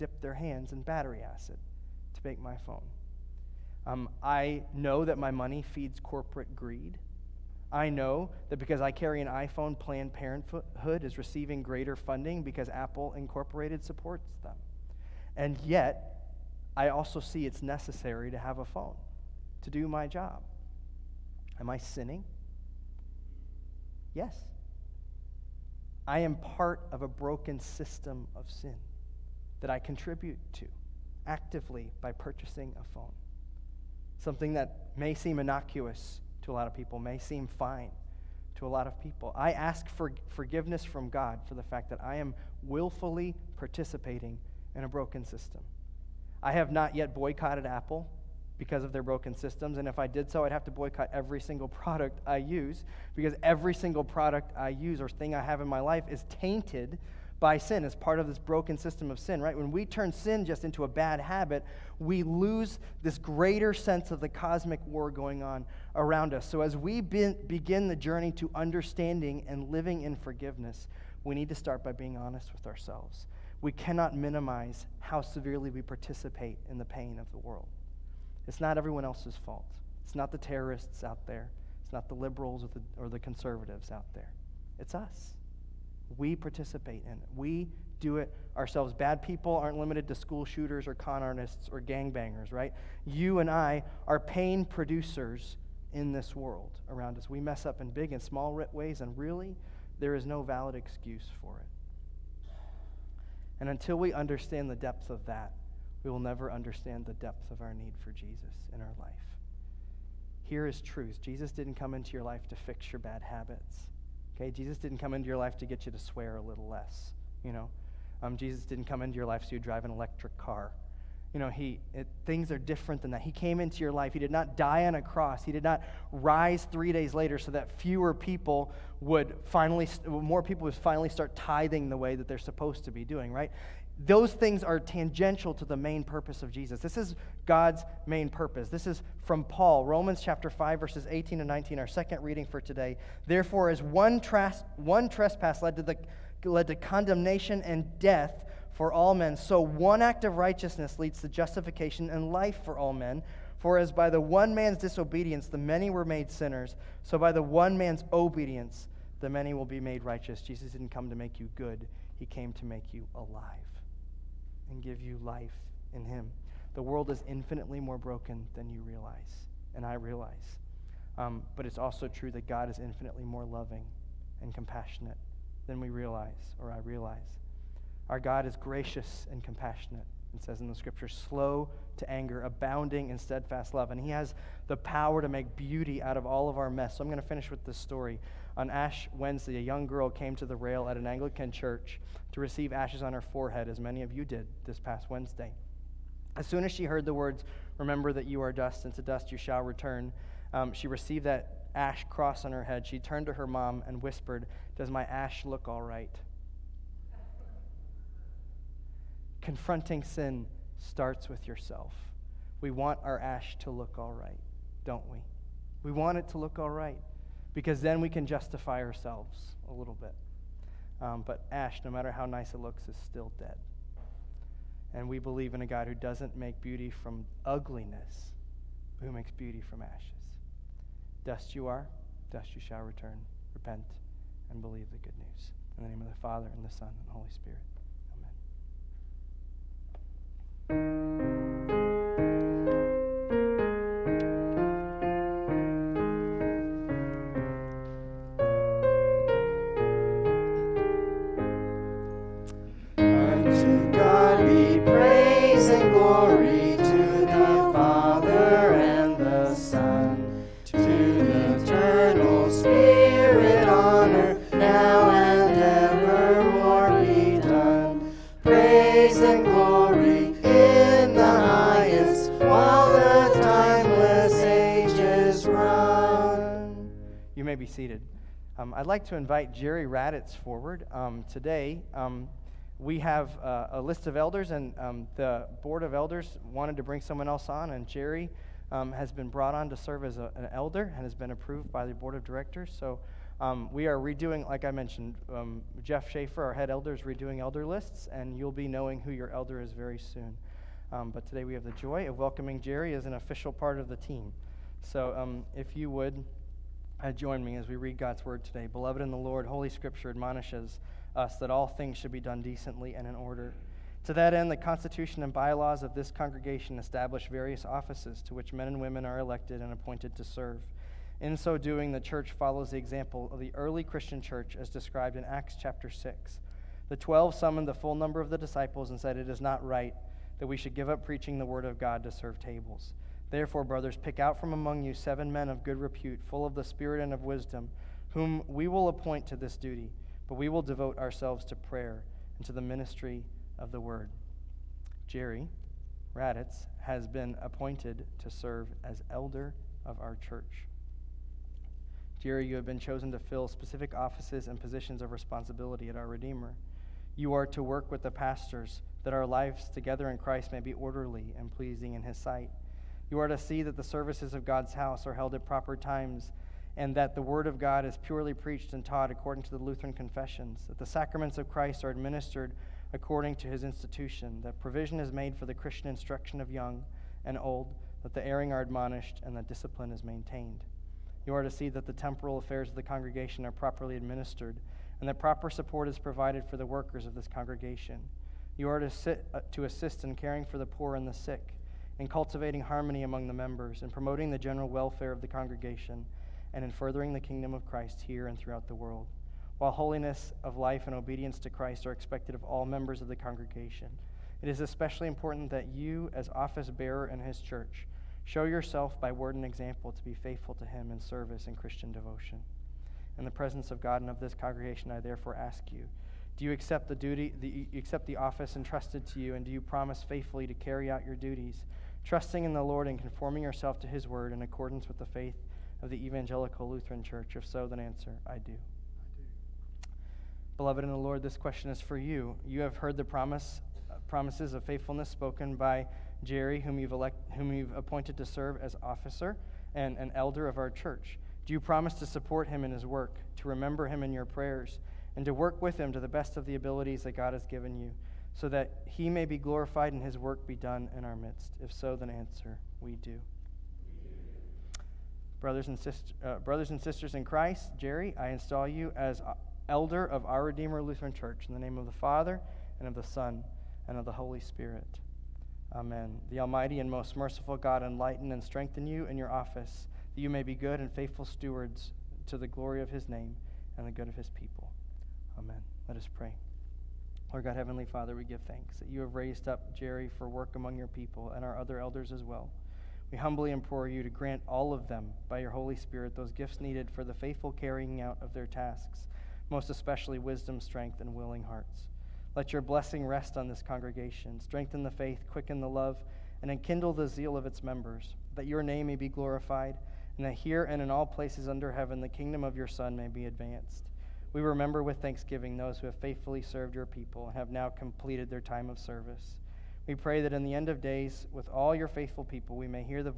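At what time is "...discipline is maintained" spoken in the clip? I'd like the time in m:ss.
6:19.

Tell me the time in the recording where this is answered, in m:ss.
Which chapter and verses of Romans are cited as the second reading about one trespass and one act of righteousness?
2:19.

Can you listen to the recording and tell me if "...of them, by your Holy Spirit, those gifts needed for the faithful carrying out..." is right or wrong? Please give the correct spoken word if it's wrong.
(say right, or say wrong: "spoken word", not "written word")
right.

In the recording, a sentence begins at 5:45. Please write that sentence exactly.
Jerry Raditz has been appointed to serve as elder of our church.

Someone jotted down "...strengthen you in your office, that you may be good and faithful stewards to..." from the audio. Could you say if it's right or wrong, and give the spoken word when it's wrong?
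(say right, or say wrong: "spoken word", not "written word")
right.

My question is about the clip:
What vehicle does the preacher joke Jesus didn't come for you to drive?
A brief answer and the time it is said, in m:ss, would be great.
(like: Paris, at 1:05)
Electric car, at 1:59.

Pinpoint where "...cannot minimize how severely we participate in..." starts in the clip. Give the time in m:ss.
1:13.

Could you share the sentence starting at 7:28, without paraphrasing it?
so that he may be glorified and his work be done in our midst?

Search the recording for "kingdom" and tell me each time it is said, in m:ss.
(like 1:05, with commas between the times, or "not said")
6:37, 8:22.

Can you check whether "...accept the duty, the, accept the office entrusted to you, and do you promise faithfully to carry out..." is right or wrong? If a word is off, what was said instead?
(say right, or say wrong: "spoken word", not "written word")
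right.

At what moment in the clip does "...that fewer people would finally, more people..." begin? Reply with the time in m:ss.
2:07.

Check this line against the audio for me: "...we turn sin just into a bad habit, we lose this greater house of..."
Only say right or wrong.
wrong.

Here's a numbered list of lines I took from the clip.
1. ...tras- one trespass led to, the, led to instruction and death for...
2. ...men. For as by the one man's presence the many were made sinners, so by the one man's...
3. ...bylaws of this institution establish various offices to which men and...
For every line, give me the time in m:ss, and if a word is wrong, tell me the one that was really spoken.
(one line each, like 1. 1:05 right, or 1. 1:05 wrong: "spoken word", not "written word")
1. 2:24 wrong: "condemnation", not "instruction"
2. 2:32 wrong: "disobedience", not "presence"
3. 5:15 wrong: "congregation", not "institution".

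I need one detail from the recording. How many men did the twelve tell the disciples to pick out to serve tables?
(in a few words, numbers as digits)
7.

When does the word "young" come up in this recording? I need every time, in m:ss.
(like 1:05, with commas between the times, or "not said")
3:09, 6:16.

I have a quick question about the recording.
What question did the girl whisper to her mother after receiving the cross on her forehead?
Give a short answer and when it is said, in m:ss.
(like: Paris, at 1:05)
Does my ash look all right?, at 3:24.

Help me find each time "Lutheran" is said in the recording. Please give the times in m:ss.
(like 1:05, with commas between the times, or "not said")
6:09, 7:06, 7:40.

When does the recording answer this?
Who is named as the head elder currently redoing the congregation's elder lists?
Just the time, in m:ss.
4:55.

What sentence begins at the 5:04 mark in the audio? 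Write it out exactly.
So um, if you would uh, join me as we read God's word today.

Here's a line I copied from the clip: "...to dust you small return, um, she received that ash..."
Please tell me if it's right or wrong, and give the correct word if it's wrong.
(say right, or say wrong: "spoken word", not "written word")
wrong: "shall", not "small".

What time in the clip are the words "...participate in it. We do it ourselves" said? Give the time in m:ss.
1:26.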